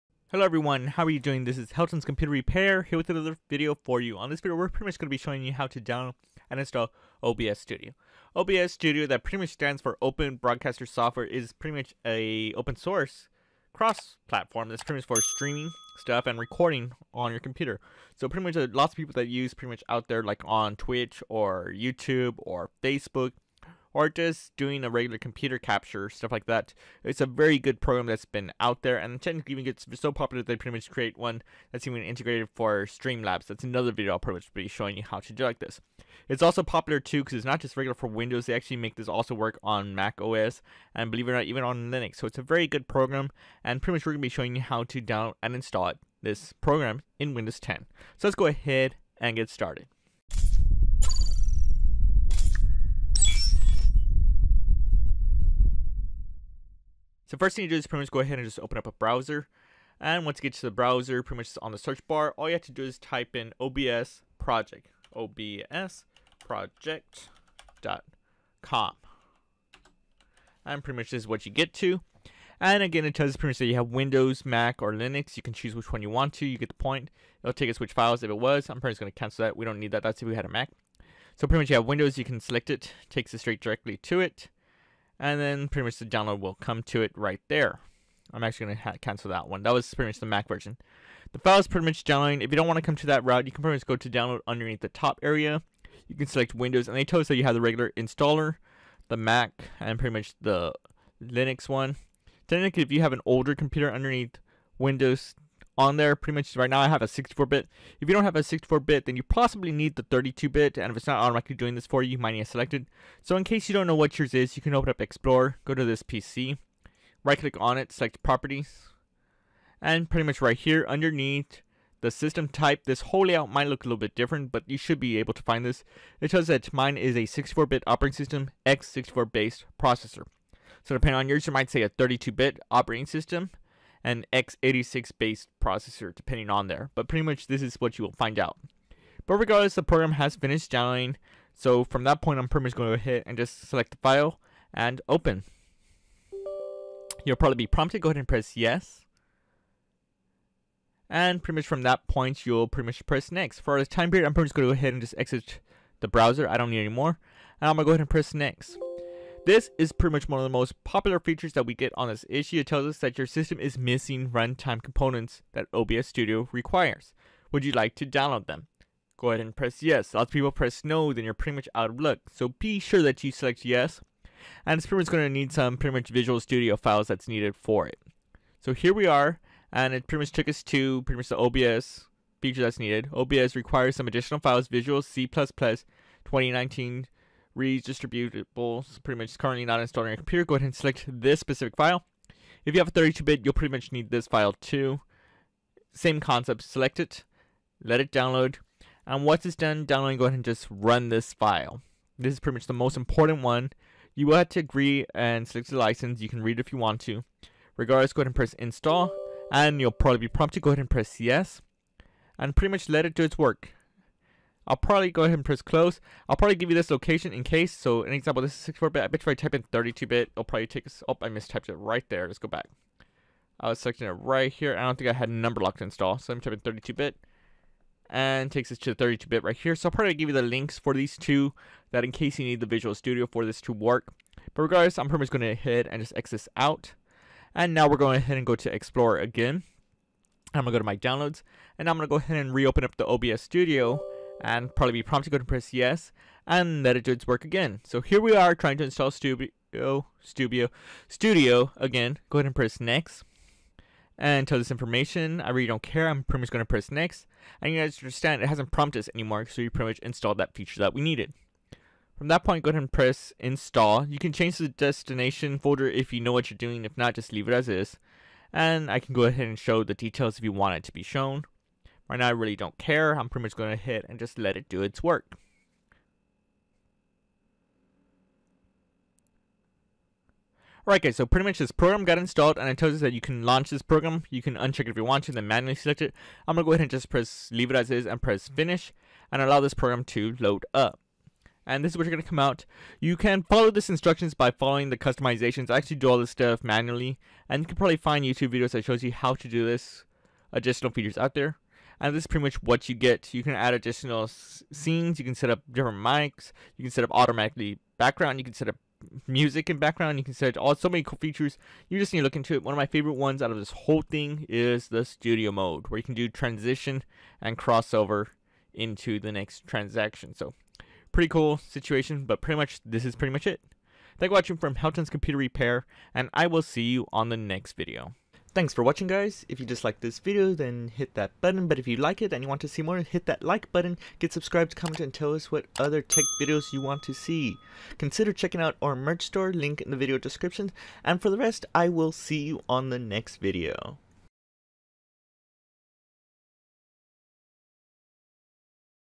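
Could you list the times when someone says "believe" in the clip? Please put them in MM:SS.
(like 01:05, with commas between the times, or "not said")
00:41.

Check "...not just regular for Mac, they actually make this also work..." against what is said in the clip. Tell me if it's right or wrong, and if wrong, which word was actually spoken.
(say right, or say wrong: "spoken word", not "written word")
wrong: "Windows", not "Mac".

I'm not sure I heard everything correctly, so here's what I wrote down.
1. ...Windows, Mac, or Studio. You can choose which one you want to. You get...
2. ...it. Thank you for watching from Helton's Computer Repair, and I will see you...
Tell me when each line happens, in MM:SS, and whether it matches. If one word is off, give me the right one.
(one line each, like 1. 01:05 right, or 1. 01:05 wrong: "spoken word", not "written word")
1. 01:13 wrong: "Linux", not "Studio"
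2. 05:23 right.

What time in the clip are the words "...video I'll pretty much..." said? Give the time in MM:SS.
00:33.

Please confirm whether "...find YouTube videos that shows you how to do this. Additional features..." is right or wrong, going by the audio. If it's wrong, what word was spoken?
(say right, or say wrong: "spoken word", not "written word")
right.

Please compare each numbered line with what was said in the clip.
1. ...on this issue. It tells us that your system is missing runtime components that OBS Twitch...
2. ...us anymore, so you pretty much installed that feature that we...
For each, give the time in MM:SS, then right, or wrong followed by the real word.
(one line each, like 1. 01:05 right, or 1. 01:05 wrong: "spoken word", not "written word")
1. 02:41 wrong: "Studio", not "Twitch"
2. 04:18 right.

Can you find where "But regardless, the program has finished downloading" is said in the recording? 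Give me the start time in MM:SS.
02:19.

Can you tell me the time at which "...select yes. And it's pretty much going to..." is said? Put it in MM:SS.
02:53.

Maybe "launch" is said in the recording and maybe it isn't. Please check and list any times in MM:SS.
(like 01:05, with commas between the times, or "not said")
04:43.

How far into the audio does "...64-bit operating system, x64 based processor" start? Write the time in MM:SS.
02:07.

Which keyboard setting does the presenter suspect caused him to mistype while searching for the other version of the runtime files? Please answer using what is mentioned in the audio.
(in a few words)
Number lock.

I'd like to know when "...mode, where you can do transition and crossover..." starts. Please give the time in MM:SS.
05:15.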